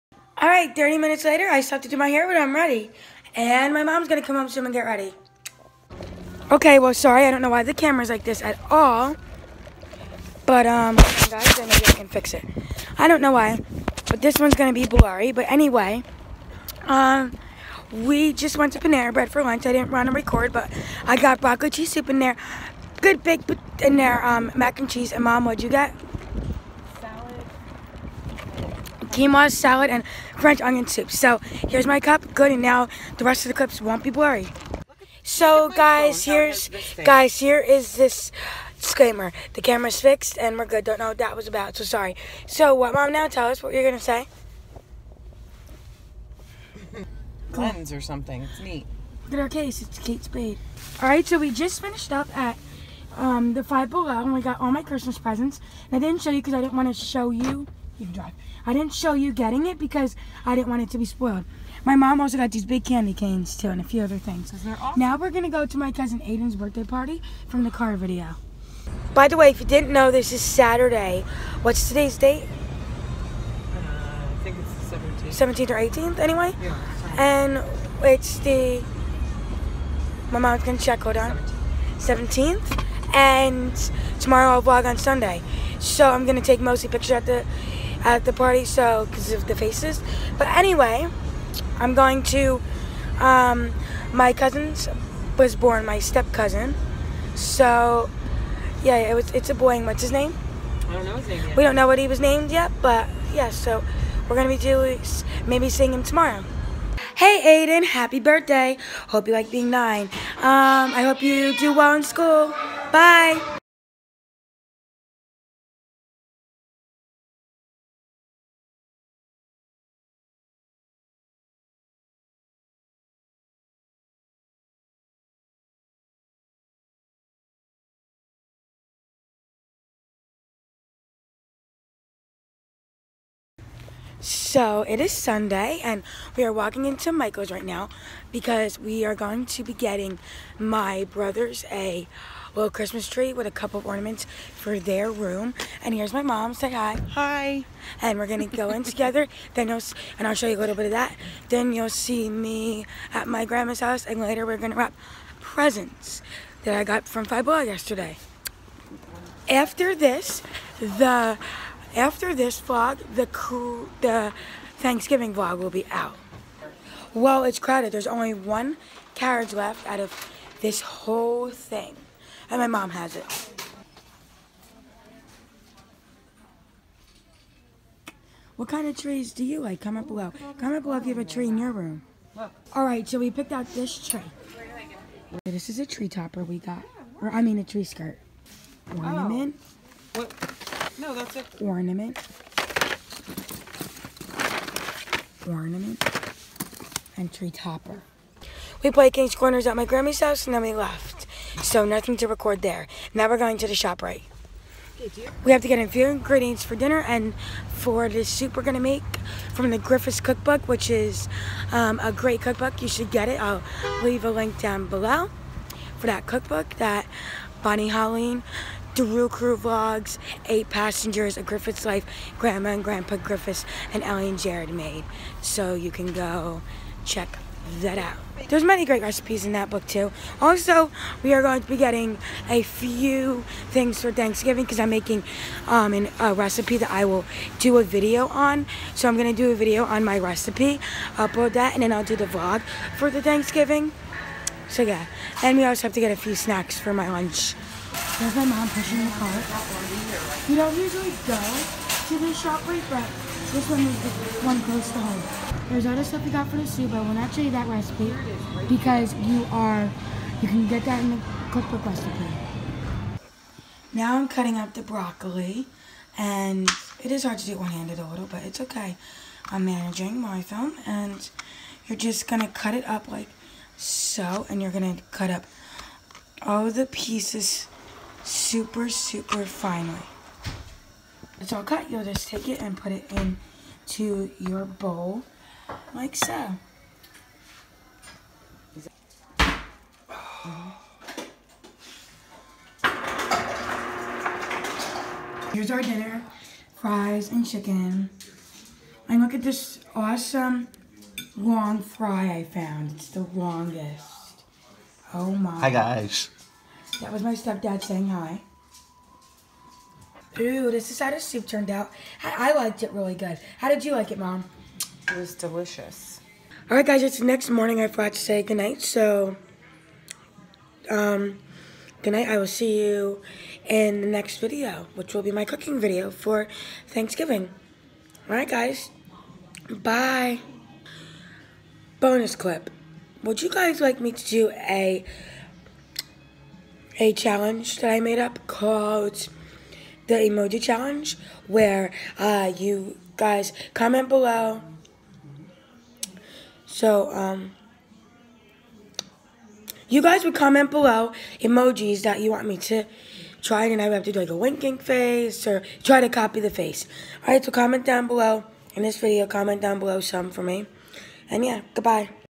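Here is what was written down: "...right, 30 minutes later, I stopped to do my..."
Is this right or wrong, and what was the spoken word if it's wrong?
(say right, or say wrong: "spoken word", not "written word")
right.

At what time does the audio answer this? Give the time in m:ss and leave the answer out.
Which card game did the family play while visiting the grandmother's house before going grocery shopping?
3:19.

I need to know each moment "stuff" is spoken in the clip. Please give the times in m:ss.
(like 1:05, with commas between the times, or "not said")
4:16.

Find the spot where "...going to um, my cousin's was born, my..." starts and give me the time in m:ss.
1:31.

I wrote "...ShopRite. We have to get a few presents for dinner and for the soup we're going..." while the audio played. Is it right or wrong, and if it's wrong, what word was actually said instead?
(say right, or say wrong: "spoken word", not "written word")
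wrong: "ingredients", not "presents".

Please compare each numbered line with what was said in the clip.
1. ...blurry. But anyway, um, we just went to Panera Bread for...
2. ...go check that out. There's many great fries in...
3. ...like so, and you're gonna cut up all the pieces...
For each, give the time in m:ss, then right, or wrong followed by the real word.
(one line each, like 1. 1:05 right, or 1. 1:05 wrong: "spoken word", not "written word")
1. 0:14 right
2. 3:46 wrong: "recipes", not "fries"
3. 4:33 right.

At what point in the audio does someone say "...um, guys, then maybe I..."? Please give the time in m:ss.
0:10.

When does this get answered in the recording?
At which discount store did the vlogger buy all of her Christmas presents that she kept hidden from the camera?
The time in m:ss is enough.
0:53.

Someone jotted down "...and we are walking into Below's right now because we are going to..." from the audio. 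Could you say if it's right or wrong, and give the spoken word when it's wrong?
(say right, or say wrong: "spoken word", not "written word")
wrong: "Michael", not "Below".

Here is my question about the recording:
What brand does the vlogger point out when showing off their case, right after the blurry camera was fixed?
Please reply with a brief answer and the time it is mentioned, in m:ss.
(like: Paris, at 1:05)
Kate Spade, at 0:49.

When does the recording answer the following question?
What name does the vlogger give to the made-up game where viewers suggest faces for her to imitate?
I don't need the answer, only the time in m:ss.
5:40.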